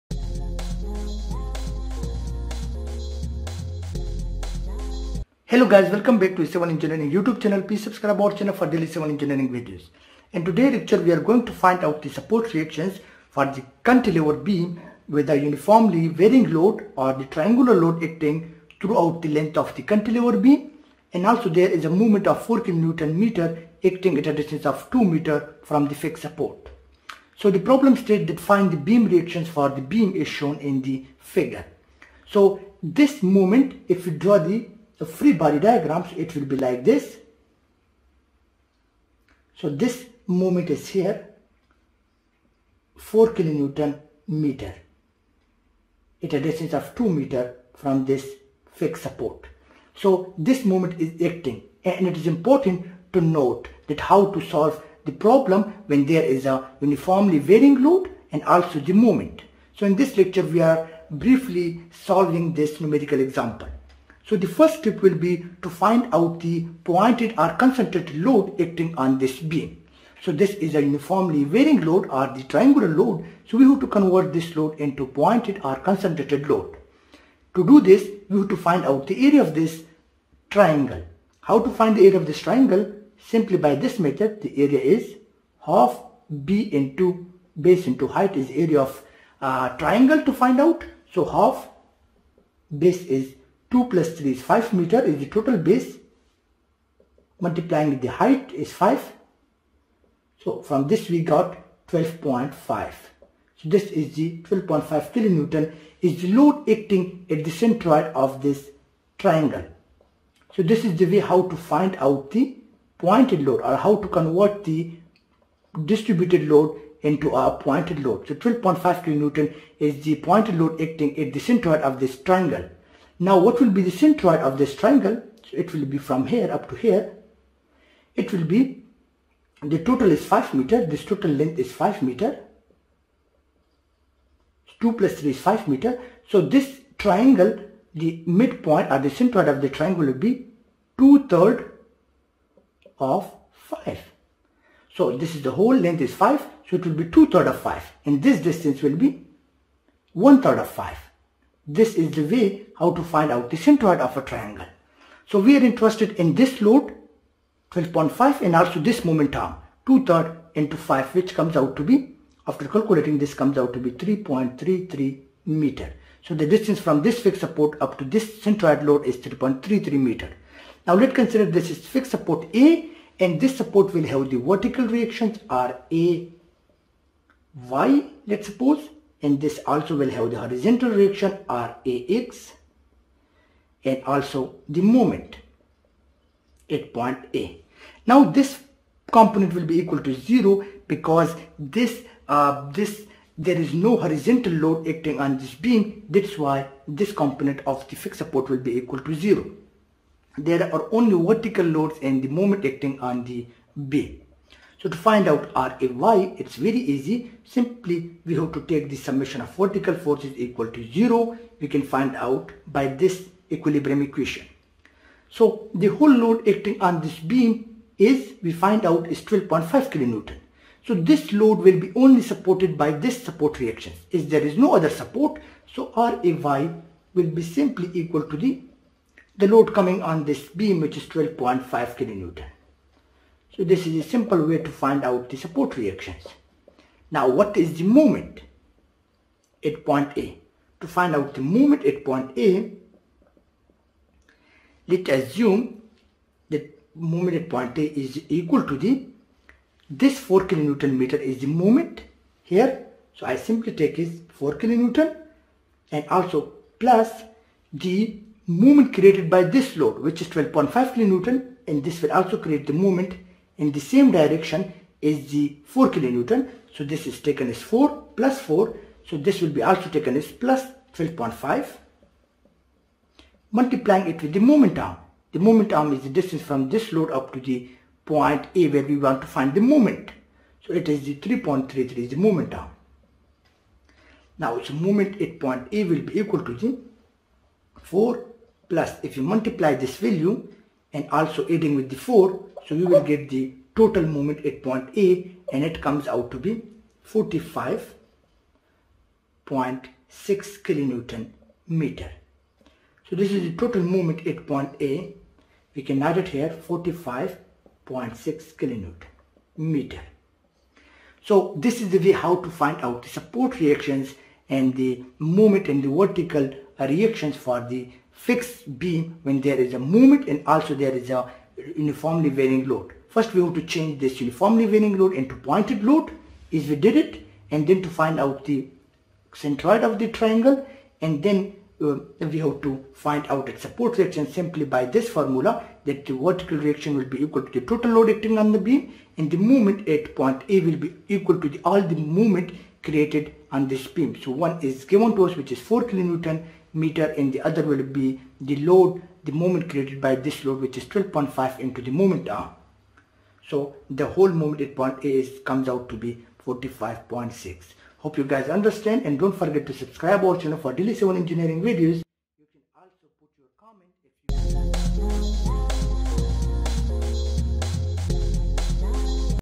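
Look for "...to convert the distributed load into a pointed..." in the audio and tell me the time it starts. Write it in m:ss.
1:54.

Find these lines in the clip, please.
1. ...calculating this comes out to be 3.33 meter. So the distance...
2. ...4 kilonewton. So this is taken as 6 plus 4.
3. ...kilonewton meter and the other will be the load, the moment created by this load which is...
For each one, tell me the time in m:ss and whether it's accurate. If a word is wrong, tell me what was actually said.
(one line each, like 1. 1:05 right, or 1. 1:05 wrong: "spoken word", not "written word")
1. 2:42 right
2. 4:25 wrong: "4", not "6"
3. 5:45 right.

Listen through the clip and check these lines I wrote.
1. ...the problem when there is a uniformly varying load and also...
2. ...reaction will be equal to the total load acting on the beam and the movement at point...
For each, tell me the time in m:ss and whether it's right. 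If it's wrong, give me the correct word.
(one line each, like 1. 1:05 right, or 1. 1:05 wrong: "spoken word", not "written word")
1. 0:55 right
2. 5:36 right.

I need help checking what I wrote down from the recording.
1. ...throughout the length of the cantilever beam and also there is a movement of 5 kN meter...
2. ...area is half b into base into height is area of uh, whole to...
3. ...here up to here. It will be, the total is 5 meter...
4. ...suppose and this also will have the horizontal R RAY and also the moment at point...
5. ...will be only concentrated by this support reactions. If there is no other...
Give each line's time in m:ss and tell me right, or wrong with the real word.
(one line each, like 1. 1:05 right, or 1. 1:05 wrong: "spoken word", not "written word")
1. 0:18 wrong: "4", not "5"
2. 1:24 wrong: "triangle", not "whole"
3. 2:06 right
4. 2:58 wrong: "RAX", not "RAY"
5. 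3:41 wrong: "supported", not "concentrated".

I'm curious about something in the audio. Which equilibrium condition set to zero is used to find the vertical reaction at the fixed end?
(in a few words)
summation of vertical forces.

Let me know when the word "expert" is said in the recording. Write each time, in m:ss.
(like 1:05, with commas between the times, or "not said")
not said.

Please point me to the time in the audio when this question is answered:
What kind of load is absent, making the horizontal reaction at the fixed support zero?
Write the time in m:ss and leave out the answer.
3:13.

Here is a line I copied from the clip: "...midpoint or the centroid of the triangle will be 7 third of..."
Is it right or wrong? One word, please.
wrong.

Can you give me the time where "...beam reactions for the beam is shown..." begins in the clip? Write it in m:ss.
0:28.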